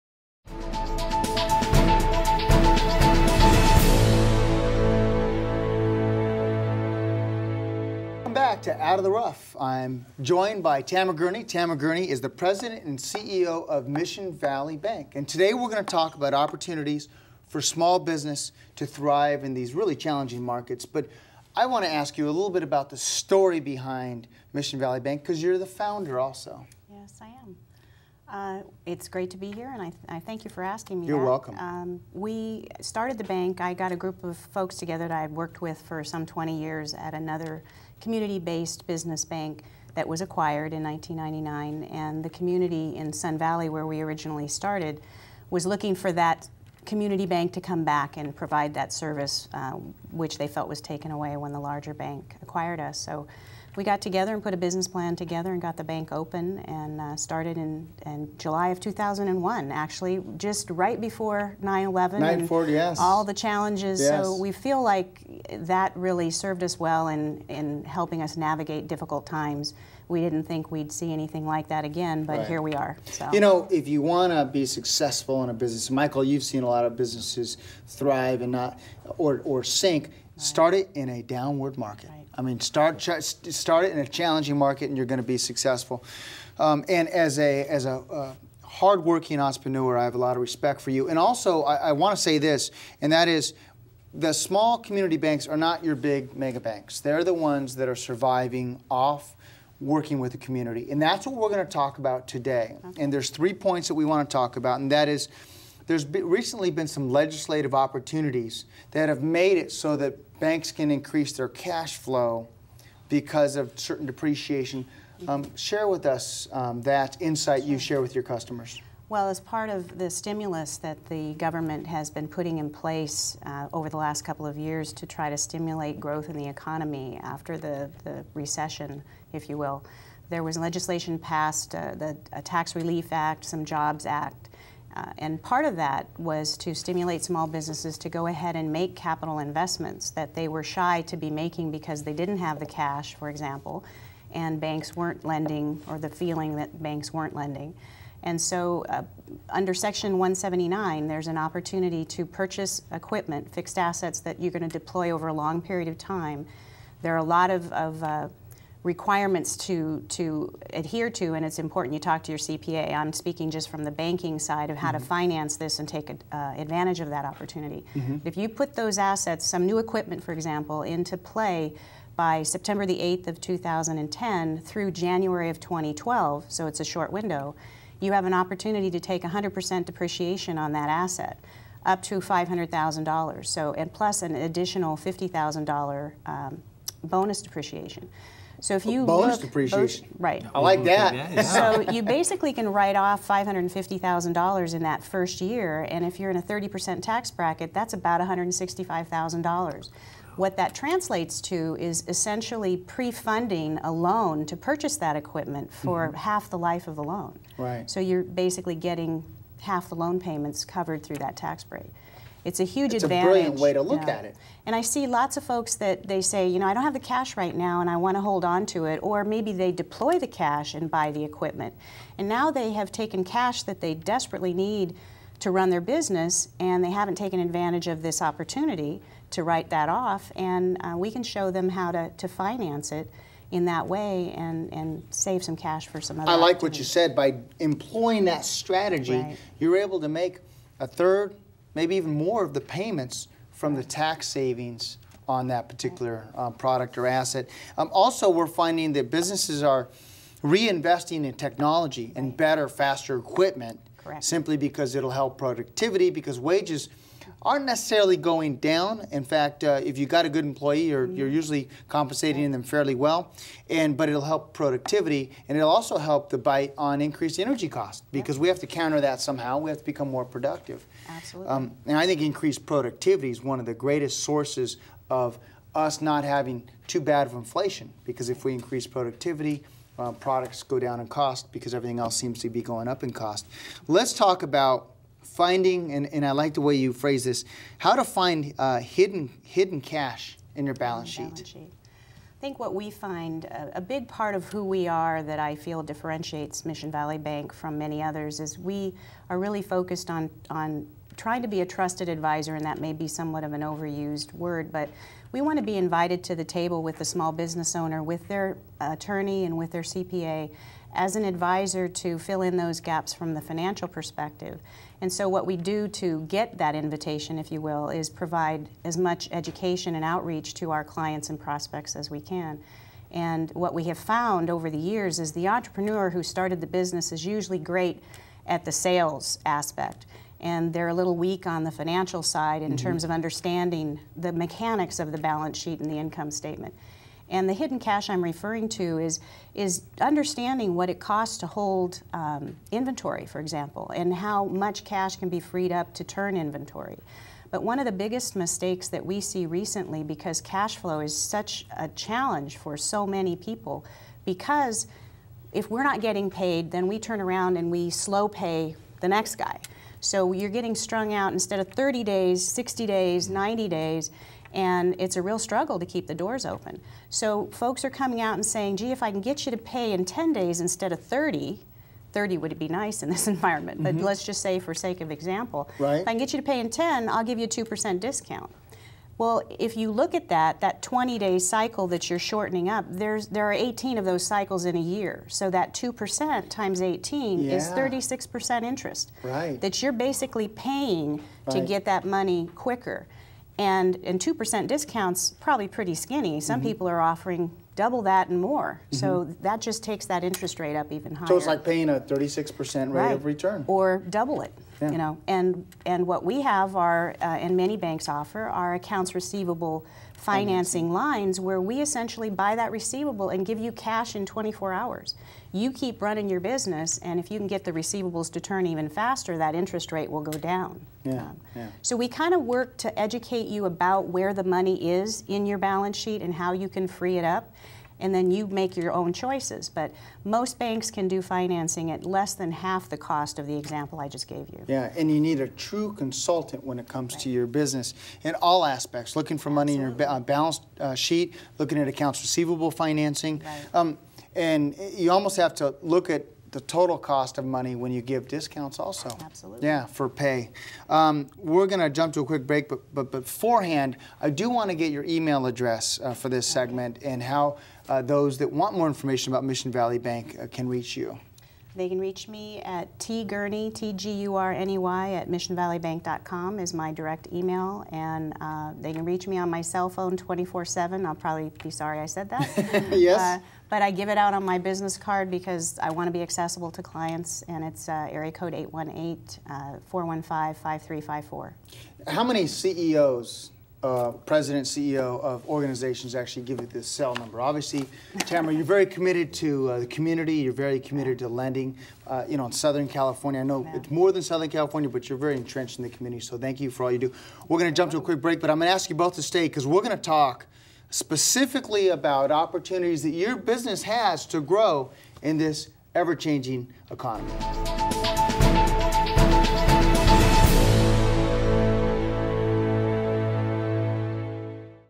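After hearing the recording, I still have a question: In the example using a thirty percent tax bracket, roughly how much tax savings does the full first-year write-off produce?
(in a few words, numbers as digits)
$165,000.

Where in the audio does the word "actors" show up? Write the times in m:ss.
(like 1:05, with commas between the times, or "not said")
not said.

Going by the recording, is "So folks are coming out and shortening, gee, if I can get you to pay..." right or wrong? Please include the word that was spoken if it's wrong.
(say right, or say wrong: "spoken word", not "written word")
wrong: "saying", not "shortening".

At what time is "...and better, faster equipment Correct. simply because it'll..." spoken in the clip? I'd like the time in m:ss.
4:12.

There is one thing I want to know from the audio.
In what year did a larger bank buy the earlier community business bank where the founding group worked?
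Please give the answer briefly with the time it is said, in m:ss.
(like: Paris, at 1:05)
1999, at 0:40.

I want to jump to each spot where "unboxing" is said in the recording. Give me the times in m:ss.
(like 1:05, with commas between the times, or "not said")
not said.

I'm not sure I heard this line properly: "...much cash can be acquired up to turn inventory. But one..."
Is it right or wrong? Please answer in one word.
wrong.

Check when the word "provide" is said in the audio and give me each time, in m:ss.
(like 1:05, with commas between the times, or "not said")
0:48, 5:18.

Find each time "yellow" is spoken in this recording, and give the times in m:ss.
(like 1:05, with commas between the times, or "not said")
not said.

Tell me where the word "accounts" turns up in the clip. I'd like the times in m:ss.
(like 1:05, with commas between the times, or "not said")
6:48, 7:21.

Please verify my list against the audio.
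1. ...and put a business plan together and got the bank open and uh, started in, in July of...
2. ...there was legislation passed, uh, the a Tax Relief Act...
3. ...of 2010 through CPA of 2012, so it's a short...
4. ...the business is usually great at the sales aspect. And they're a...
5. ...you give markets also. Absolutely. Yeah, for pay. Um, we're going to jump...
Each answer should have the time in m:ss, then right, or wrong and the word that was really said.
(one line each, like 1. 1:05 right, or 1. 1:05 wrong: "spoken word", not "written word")
1. 0:54 right
2. 2:10 right
3. 2:53 wrong: "January", not "CPA"
4. 5:26 right
5. 7:27 wrong: "discounts", not "markets".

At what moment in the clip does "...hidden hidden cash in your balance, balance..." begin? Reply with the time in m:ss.
4:48.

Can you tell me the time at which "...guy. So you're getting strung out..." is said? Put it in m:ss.
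5:59.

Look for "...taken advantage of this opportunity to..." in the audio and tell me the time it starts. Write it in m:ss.
3:47.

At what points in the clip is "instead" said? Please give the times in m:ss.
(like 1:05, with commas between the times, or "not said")
6:01, 6:10.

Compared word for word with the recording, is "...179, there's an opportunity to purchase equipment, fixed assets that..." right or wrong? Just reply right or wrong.
right.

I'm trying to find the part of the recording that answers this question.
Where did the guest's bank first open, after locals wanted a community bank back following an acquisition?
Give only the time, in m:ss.
0:43.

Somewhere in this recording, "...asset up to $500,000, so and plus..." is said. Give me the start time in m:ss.
3:00.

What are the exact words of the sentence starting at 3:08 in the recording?
So if you bonus look, depreciation, bonus, right?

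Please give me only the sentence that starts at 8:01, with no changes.
Uh, How many CEOs uh, president, CEO of organizations actually give you this cell number.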